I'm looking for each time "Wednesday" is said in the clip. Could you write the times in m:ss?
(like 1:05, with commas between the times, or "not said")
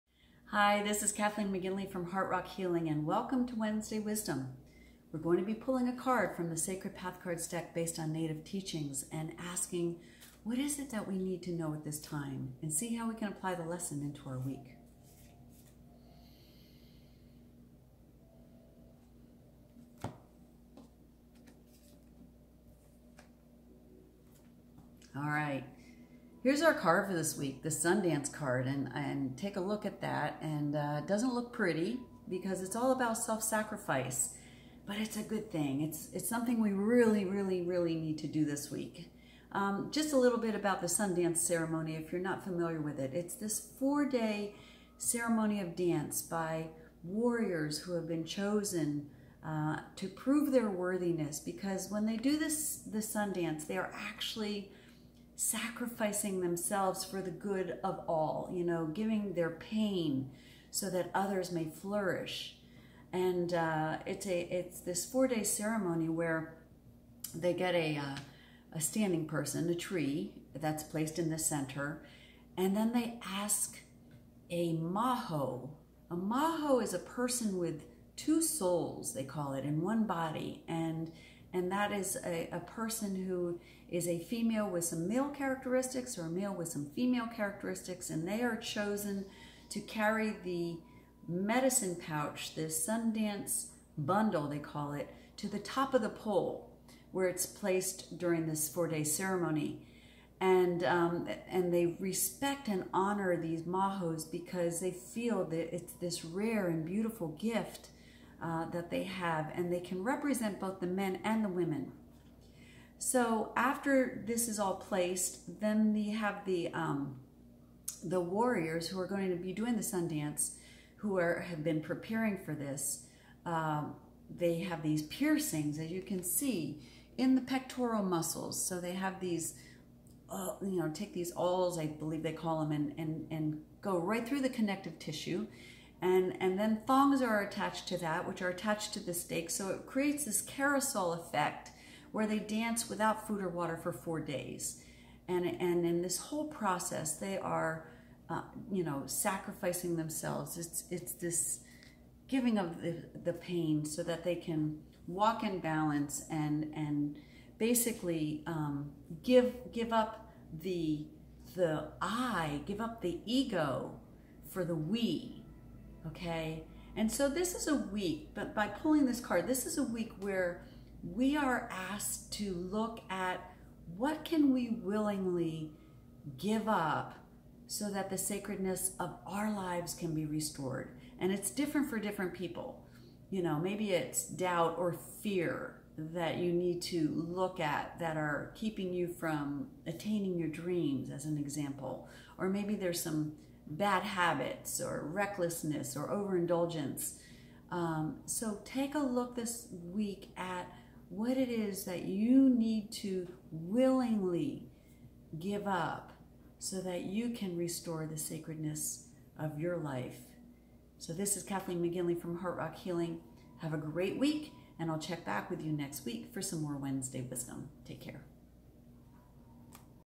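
0:03, 3:36.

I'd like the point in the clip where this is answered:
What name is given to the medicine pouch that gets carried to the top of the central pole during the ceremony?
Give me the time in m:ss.
1:32.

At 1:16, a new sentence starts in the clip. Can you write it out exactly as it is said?
A maho is a person with two souls, they call it, in one body.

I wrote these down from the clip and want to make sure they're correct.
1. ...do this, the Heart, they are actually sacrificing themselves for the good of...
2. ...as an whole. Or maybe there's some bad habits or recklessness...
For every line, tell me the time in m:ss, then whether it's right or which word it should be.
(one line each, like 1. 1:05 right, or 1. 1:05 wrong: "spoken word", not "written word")
1. 0:52 wrong: "Sundance", not "Heart"
2. 3:11 wrong: "example", not "whole".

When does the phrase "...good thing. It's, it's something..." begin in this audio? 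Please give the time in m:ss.
0:35.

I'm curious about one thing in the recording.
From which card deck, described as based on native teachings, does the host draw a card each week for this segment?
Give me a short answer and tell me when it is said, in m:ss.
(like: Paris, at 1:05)
Sacred Path, at 0:06.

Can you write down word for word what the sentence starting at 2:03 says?
Uh, they have these piercings, as you can see, in the pectoral muscles.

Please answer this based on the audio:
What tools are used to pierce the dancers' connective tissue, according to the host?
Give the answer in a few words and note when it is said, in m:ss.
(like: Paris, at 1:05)
Awls, at 2:11.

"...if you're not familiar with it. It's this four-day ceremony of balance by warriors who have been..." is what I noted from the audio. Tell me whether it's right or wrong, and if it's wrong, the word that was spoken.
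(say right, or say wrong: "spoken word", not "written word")
wrong: "dance", not "balance".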